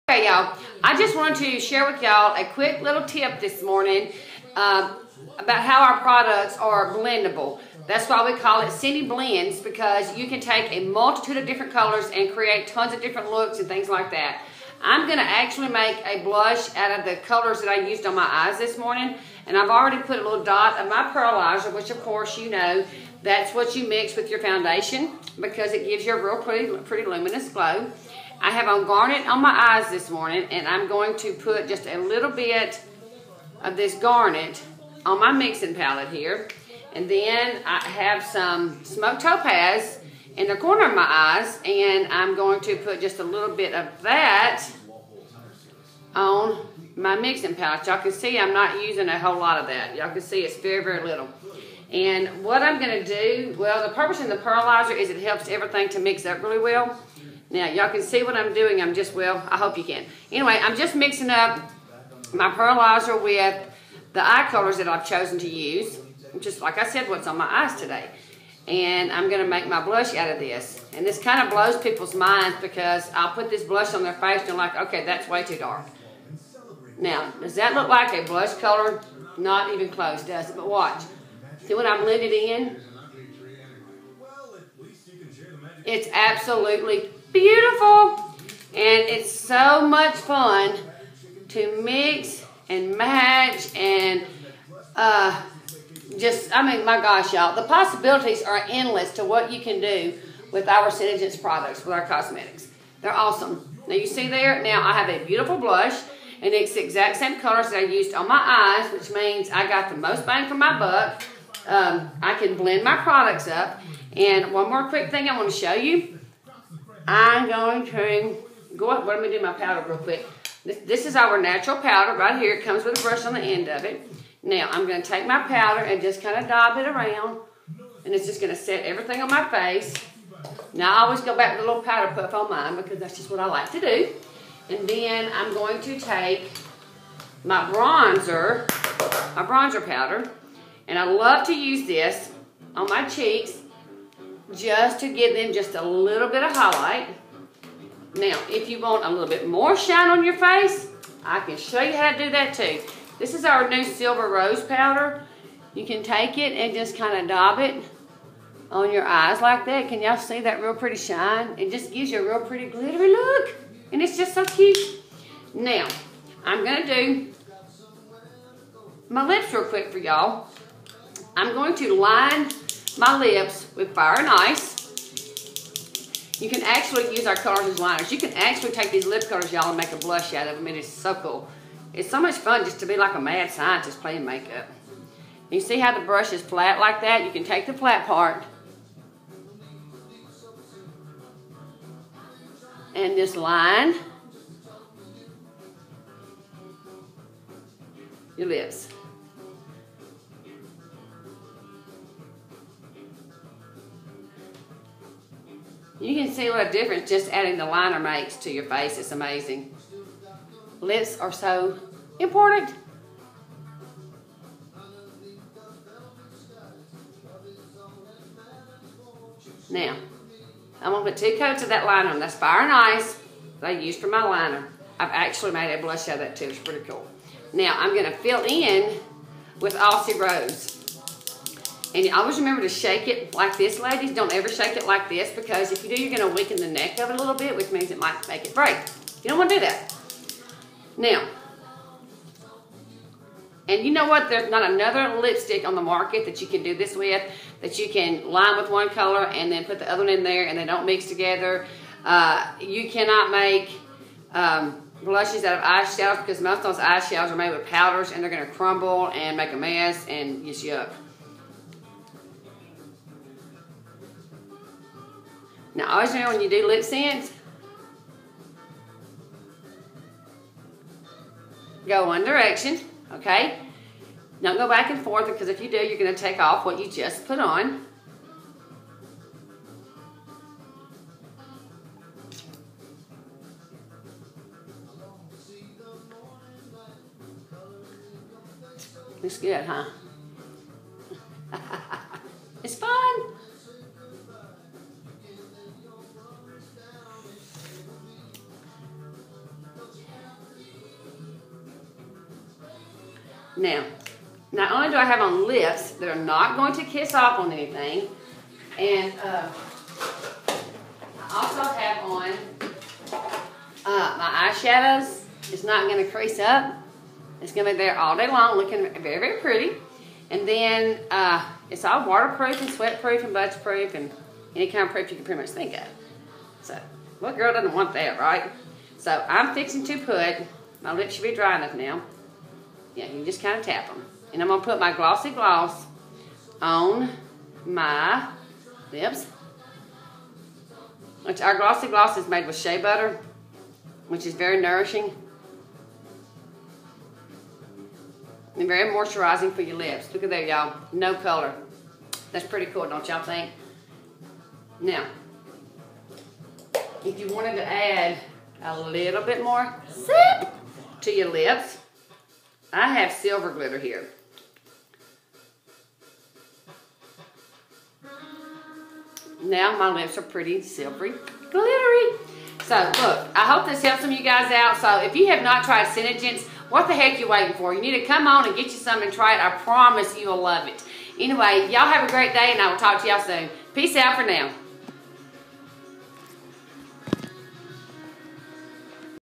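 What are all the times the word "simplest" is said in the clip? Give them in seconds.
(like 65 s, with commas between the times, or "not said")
not said.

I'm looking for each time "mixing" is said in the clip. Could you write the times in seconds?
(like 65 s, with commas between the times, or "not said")
35 s, 47 s, 60 s.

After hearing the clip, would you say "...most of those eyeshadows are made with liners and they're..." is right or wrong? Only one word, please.
wrong.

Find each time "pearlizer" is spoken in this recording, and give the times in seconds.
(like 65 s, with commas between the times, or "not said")
21 s, 54 s, 62 s.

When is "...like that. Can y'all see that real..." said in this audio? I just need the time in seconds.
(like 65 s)
159 s.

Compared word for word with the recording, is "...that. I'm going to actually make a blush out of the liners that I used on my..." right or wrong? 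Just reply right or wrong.
wrong.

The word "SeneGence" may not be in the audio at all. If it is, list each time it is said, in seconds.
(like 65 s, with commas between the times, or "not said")
100 s, 375 s.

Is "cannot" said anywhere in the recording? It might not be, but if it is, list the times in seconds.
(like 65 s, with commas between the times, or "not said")
252 s.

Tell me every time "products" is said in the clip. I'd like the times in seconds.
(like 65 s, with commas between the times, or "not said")
6 s, 101 s, 112 s.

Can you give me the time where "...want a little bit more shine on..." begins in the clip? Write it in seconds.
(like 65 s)
148 s.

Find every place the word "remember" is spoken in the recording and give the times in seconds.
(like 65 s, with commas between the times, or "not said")
232 s.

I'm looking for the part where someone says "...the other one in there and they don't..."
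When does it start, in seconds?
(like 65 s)
249 s.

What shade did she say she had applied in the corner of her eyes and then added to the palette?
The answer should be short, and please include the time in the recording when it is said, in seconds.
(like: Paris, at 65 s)
Smoked Topaz, at 38 s.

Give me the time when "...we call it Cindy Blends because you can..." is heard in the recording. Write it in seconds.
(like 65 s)
8 s.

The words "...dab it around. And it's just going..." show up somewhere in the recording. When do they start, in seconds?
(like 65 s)
126 s.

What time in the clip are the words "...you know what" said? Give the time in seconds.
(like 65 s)
243 s.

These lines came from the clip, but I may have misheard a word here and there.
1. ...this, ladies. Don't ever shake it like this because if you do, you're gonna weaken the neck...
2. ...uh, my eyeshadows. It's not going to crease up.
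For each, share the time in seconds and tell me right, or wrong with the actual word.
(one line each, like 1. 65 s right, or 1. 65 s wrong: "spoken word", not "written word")
1. 233 s right
2. 313 s right.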